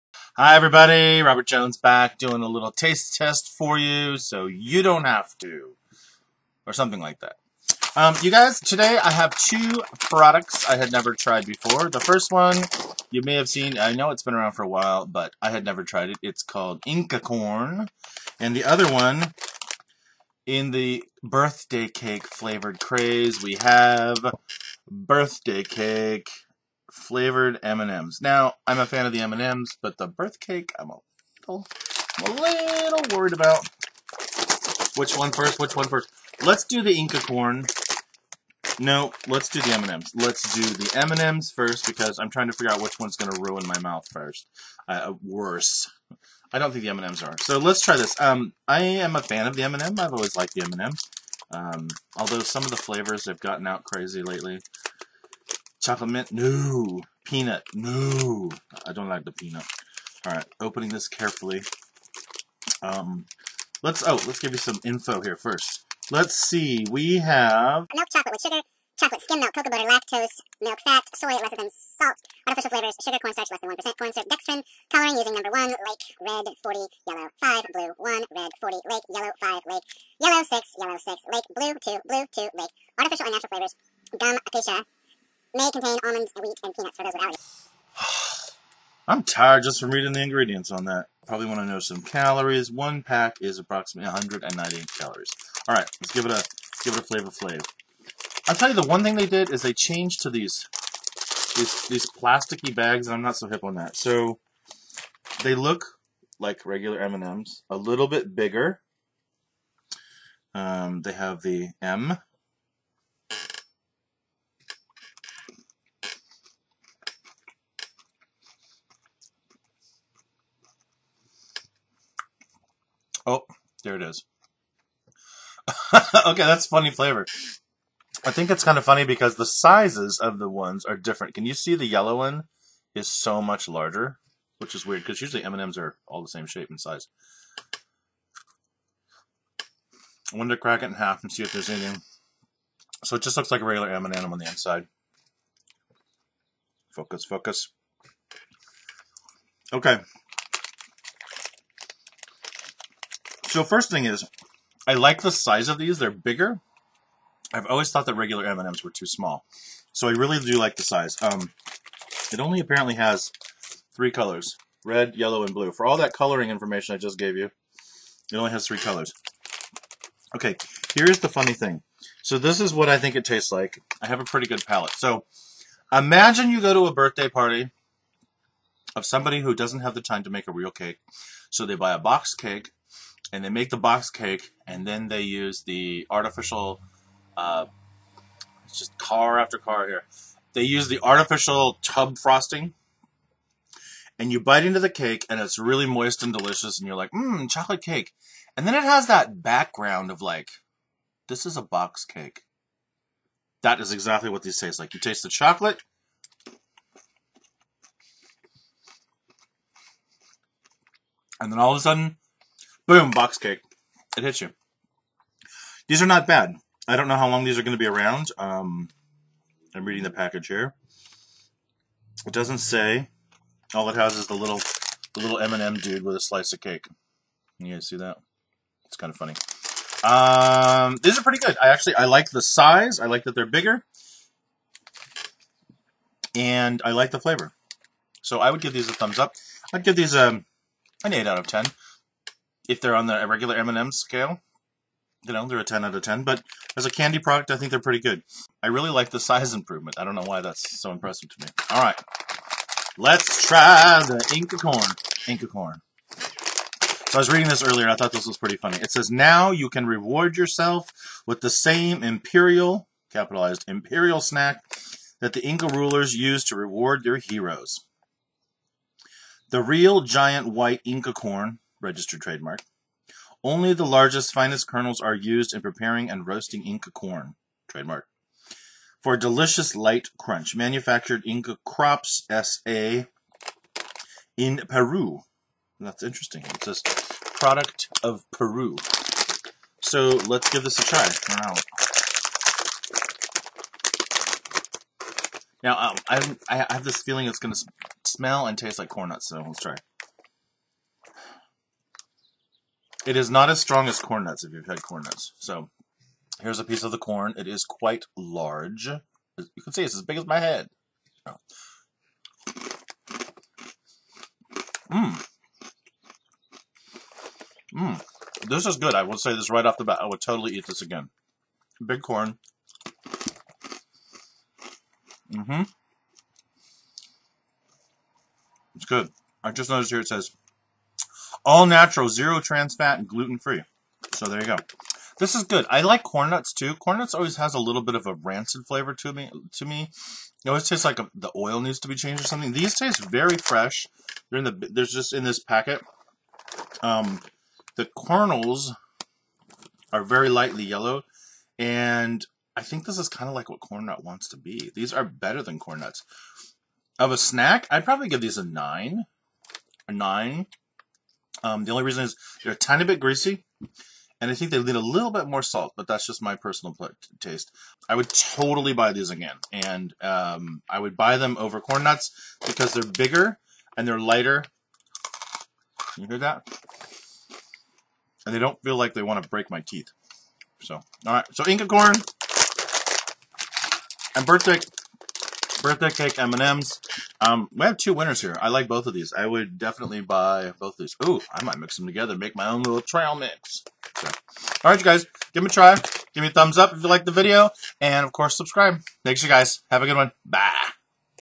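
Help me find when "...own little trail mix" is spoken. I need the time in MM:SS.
06:32.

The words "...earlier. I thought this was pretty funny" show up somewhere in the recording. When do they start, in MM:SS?
04:17.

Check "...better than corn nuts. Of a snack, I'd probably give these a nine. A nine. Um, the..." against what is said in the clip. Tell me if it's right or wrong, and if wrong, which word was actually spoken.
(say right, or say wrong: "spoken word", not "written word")
right.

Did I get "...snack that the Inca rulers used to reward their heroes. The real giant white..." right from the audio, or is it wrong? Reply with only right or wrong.
right.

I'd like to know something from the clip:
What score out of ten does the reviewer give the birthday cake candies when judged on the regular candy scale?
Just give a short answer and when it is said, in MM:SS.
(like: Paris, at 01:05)
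8 out of 10, at 04:01.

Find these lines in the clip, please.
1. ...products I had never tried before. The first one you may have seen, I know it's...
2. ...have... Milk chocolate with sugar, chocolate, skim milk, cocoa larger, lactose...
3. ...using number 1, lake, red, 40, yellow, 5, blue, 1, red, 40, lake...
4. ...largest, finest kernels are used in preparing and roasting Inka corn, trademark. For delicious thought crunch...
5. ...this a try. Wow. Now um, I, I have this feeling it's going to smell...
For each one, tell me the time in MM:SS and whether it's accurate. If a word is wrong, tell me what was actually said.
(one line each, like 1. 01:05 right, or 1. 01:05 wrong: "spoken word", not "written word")
1. 00:09 right
2. 01:07 wrong: "butter", not "larger"
3. 01:15 right
4. 04:33 wrong: "light", not "thought"
5. 04:50 right.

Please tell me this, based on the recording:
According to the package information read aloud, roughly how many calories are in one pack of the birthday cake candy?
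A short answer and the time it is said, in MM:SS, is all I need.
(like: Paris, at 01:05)
198, at 01:34.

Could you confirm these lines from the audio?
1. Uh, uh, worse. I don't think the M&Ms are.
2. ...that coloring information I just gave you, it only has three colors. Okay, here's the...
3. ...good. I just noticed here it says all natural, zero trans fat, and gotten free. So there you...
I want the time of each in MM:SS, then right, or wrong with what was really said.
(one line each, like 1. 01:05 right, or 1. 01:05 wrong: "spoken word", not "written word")
1. 00:44 right
2. 02:45 right
3. 05:28 wrong: "gluten", not "gotten".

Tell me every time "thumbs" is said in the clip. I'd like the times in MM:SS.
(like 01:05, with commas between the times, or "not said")
03:58, 06:36.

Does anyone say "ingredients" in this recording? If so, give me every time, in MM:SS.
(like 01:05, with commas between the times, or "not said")
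01:30.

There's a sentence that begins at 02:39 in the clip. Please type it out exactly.
So I really do like the size.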